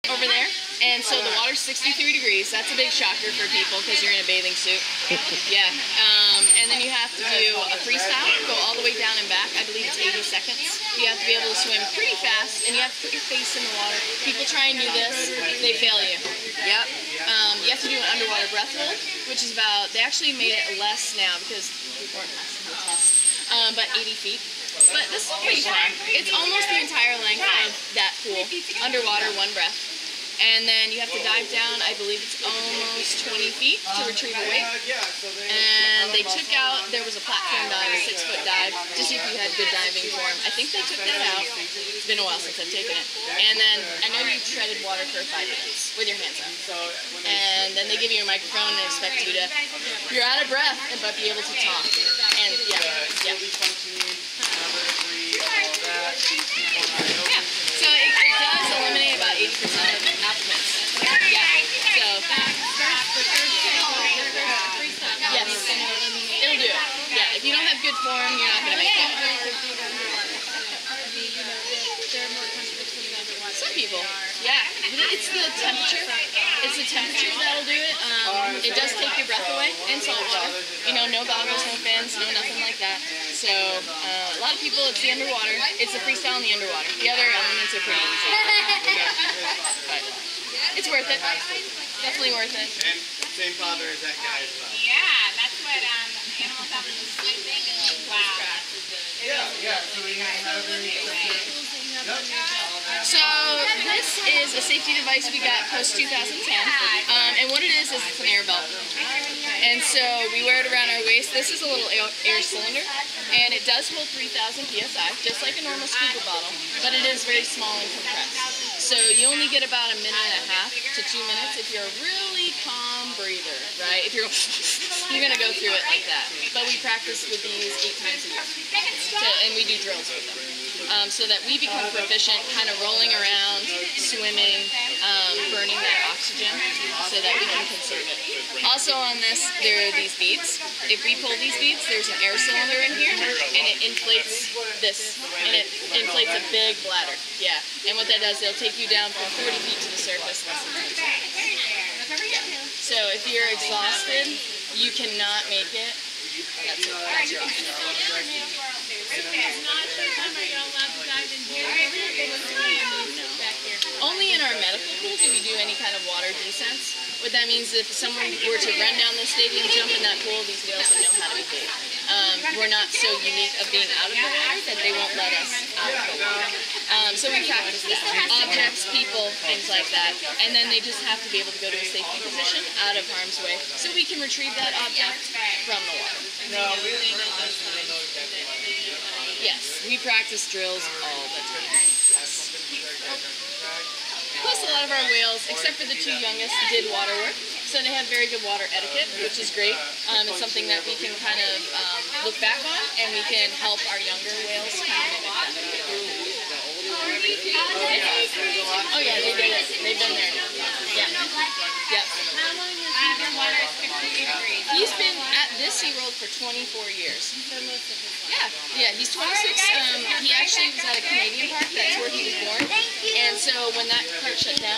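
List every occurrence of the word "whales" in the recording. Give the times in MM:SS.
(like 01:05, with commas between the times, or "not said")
03:15, 03:24.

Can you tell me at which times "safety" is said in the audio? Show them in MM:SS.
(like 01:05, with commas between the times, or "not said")
01:44, 03:01.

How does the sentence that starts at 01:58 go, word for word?
So you only get about a minute and a half to two minutes if you're a really calm breather, right?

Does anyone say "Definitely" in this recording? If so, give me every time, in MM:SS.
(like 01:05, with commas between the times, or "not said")
01:32.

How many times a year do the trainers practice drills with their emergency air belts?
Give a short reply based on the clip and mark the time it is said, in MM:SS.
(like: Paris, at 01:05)
8 times a year, at 02:07.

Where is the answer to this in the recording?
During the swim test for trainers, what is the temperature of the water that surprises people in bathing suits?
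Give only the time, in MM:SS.
00:01.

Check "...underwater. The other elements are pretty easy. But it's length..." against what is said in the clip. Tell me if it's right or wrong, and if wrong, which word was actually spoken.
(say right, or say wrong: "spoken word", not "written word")
wrong: "worth", not "length".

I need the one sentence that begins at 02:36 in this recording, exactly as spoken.
That's Only in our medical pool do we do any kind of water descents.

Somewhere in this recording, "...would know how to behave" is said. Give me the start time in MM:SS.
02:50.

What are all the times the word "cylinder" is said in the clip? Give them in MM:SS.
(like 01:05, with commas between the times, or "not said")
01:52, 02:22.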